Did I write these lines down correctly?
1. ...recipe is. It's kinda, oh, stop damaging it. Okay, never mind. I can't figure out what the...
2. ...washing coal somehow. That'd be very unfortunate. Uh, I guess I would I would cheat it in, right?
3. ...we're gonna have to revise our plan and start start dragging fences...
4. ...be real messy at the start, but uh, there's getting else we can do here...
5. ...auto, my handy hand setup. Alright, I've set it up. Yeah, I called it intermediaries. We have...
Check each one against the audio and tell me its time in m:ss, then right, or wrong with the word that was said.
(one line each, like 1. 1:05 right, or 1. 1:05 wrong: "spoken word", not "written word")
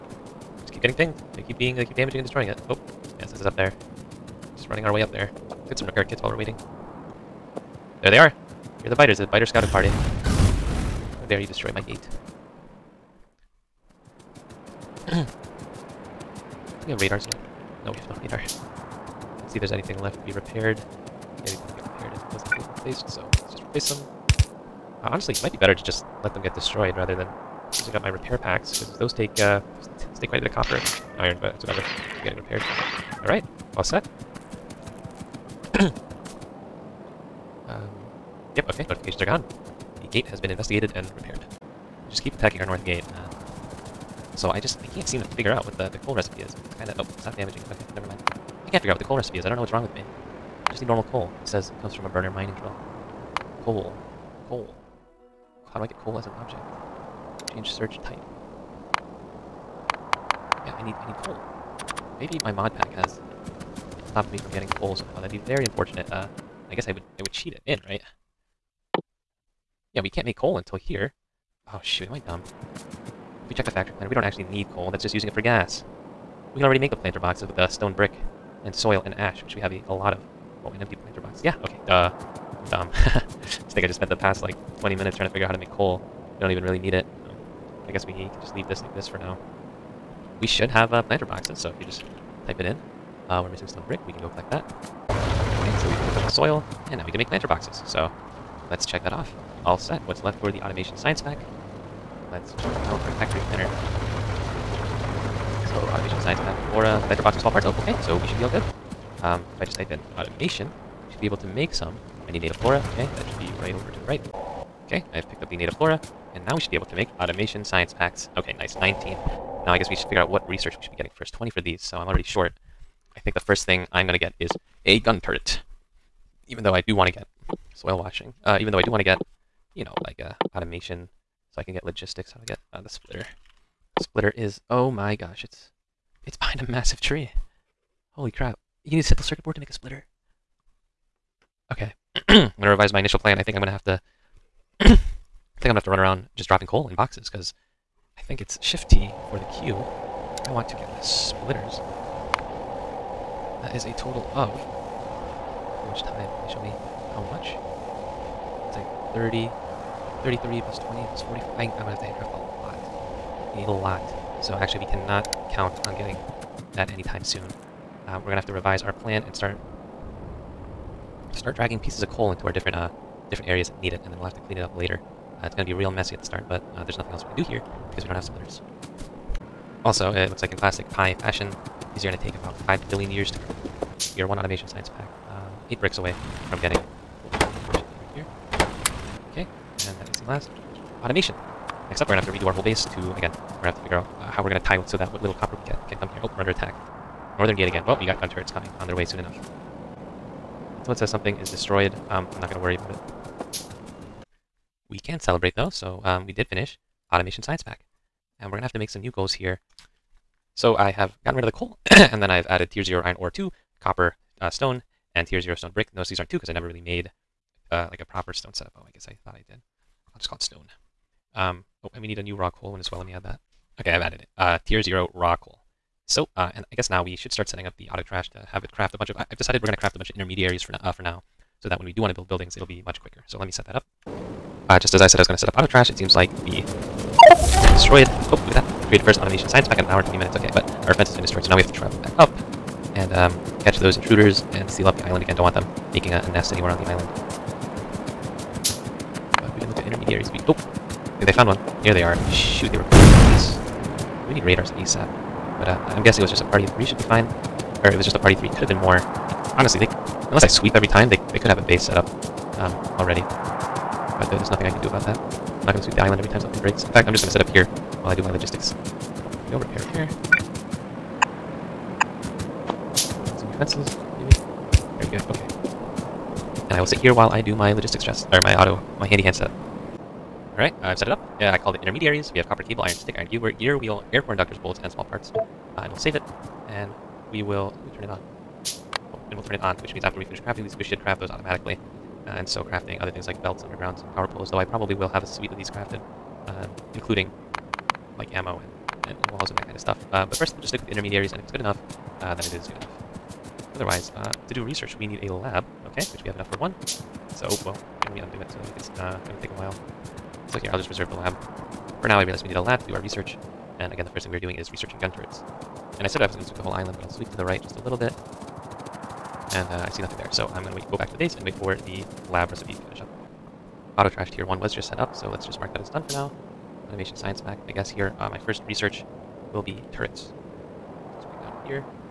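1. 0:46 right
2. 1:04 wrong: "getting", not "washing"
3. 2:48 wrong: "pieces", not "fences"
4. 2:55 wrong: "nothing", not "getting"
5. 4:38 right.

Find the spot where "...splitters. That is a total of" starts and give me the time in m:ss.
2:31.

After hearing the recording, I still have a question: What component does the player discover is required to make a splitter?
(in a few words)
simple circuit board.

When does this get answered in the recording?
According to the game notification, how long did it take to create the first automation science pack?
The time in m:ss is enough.
3:59.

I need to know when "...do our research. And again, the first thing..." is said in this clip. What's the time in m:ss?
5:12.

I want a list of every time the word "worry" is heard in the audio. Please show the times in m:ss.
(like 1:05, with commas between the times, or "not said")
3:22.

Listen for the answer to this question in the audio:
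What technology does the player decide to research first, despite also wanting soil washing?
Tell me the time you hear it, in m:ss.
2:04.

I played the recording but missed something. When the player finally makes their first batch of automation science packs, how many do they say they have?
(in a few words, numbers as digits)
19.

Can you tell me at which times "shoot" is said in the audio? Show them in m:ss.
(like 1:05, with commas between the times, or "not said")
1:11, 4:12.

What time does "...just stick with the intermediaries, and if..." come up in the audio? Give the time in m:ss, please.
5:00.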